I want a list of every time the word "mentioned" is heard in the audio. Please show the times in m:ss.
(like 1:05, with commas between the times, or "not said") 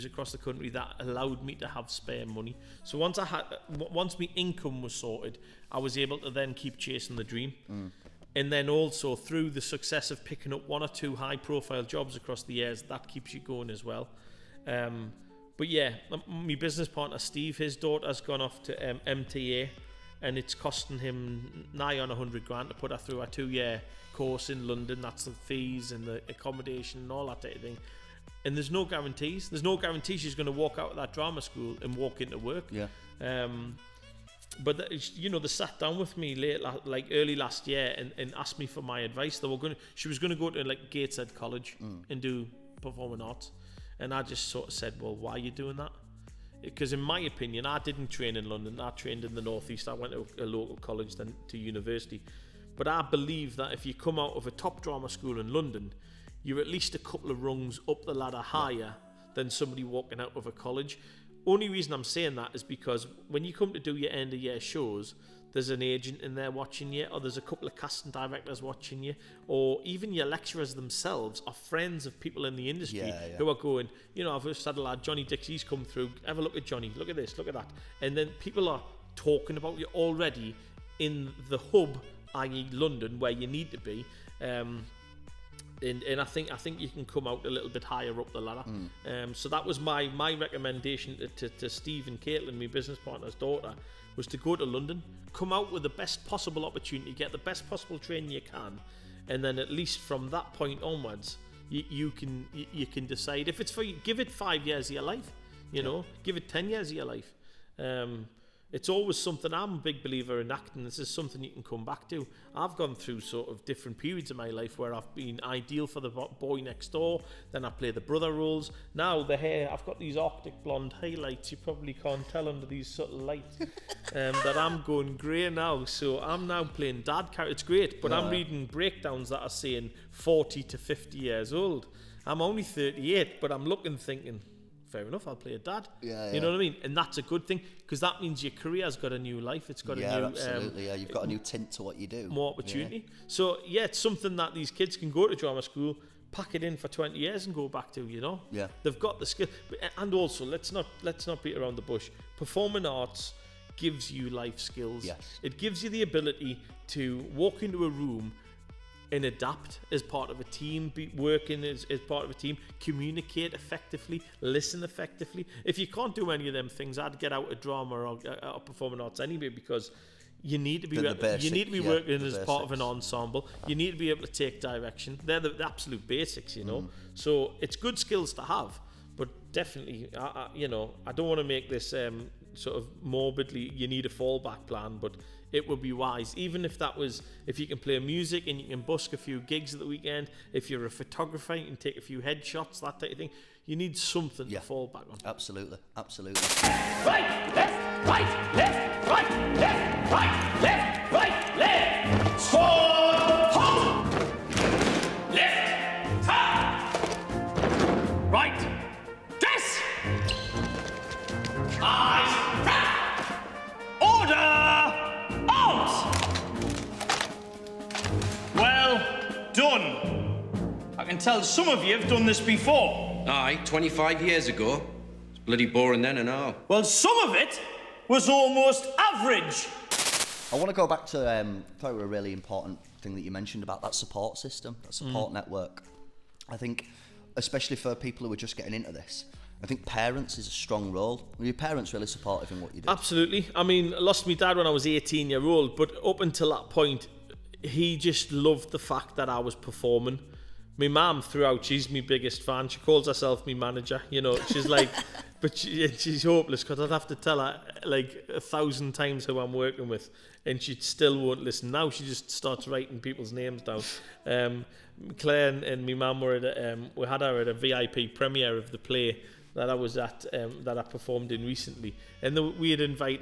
3:53.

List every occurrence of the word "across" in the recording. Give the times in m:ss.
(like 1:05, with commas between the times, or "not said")
0:00, 0:12.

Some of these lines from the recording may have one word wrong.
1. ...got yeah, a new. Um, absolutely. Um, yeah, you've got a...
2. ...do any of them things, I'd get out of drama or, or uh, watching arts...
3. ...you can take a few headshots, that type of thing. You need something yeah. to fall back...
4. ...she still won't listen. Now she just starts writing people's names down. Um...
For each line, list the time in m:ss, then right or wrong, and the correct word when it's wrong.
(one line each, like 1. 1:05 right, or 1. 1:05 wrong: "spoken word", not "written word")
1. 2:19 right
2. 2:46 wrong: "performing", not "watching"
3. 3:11 right
4. 4:20 right.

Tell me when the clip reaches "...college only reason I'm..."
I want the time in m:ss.
1:00.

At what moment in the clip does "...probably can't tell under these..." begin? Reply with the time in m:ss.
2:01.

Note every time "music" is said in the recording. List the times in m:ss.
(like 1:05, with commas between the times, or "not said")
3:07.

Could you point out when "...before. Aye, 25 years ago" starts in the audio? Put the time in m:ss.
3:42.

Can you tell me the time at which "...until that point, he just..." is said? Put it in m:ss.
4:06.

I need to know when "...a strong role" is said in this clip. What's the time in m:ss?
4:00.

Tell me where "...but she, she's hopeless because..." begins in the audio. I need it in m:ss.
4:15.